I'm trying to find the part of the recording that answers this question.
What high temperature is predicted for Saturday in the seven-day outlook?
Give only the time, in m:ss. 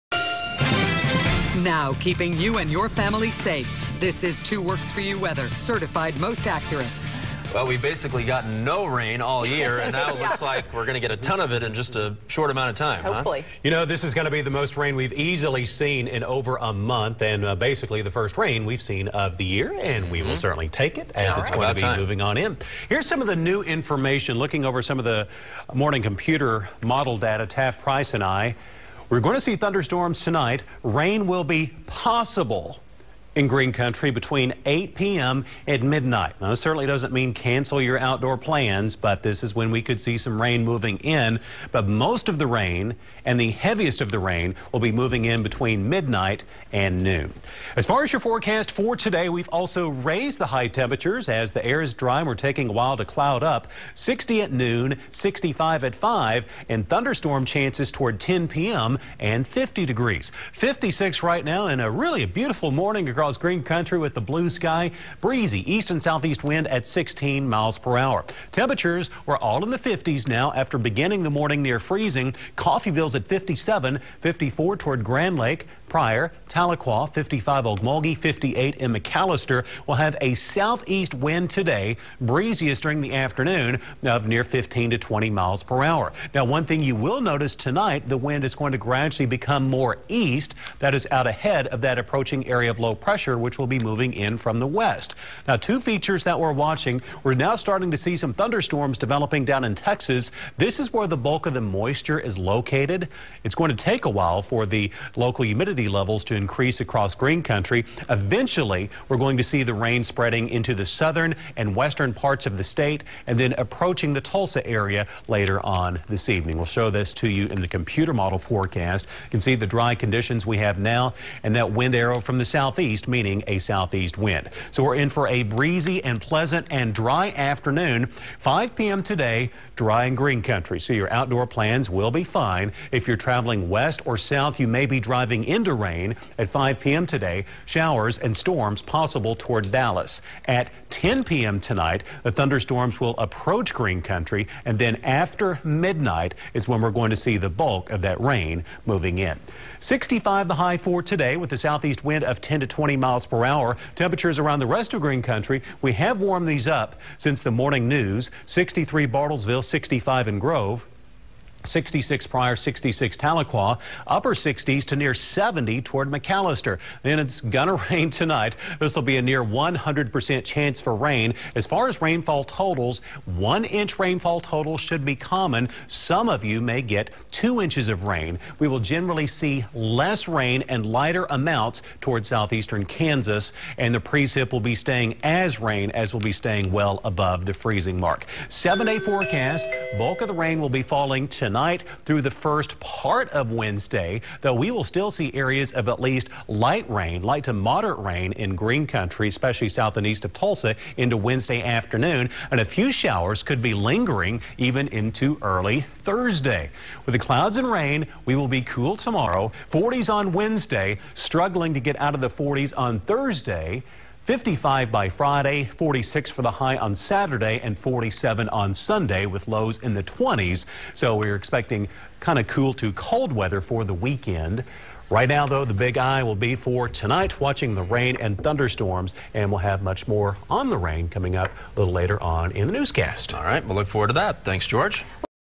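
3:35.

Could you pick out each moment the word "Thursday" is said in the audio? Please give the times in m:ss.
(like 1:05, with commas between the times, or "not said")
3:26, 3:33.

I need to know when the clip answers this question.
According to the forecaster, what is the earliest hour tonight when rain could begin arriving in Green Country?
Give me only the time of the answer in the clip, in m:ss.
0:34.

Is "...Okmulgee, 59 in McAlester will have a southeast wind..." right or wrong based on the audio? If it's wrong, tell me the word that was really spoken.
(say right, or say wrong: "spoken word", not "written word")
wrong: "58", not "59".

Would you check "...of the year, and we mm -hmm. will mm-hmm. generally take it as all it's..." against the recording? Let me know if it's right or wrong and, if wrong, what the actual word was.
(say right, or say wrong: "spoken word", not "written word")
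wrong: "certainly", not "generally".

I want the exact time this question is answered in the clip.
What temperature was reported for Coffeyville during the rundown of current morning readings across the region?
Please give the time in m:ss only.
1:13.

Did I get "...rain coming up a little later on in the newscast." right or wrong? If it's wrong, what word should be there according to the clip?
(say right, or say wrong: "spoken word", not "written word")
right.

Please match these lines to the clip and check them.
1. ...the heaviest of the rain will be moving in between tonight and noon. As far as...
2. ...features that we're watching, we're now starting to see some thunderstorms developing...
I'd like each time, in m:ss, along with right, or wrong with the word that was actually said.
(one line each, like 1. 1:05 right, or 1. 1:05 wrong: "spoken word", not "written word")
1. 0:43 wrong: "midnight", not "tonight"
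2. 1:35 right.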